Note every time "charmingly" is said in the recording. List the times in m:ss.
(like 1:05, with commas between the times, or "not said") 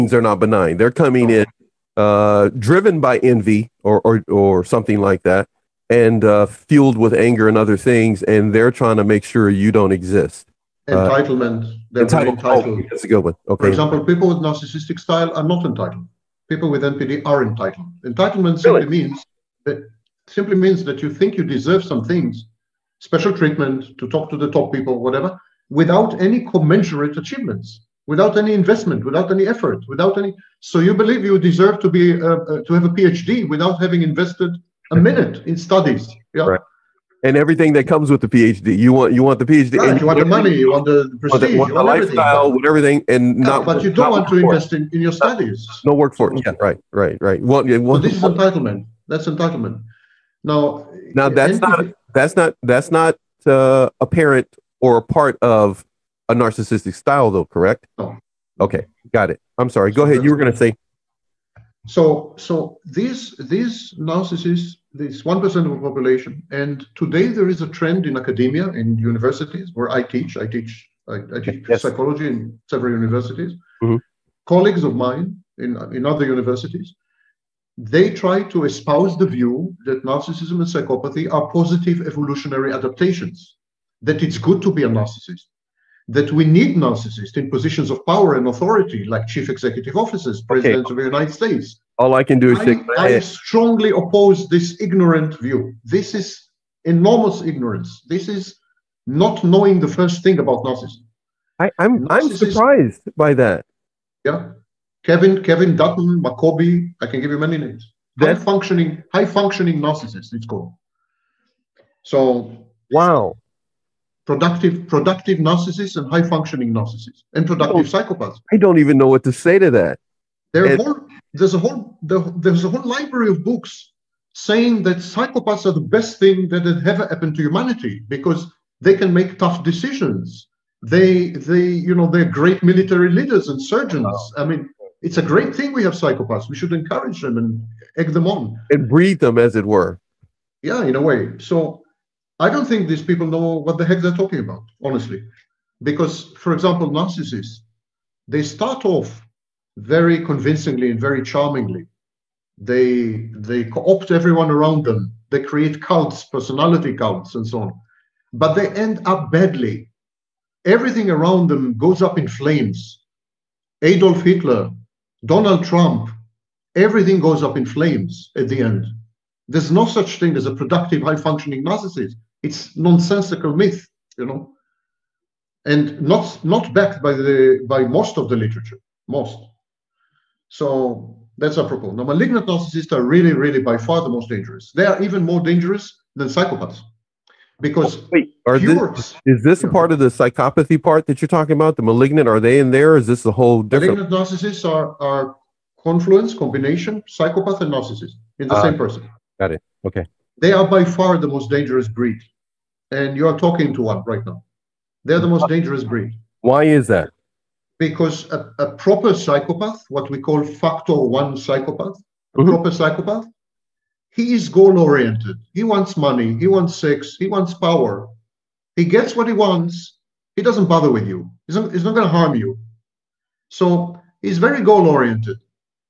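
2:31.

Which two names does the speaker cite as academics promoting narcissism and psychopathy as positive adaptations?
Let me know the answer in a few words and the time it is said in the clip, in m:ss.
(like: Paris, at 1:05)
Kevin Dutton, Maccoby, at 1:45.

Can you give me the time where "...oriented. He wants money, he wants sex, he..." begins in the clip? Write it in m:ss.
3:34.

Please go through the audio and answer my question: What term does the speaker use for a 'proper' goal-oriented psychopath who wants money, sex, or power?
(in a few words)
Factor one psychopath.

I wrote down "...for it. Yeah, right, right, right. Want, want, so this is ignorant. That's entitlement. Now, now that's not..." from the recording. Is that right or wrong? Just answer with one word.
wrong.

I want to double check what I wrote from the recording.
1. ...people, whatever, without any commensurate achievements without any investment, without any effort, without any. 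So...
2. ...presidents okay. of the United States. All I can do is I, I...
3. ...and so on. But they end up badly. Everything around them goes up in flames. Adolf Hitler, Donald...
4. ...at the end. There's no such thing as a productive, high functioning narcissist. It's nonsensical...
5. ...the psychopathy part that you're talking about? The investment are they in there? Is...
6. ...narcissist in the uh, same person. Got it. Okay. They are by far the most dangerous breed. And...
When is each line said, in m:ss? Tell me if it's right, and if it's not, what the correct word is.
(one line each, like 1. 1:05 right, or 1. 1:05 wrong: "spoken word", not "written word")
1. 0:24 right
2. 1:30 right
3. 2:37 right
4. 2:48 right
5. 3:09 wrong: "malignant", not "investment"
6. 3:17 right.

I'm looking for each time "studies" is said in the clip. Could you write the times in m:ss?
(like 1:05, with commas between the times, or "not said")
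0:35, 0:45.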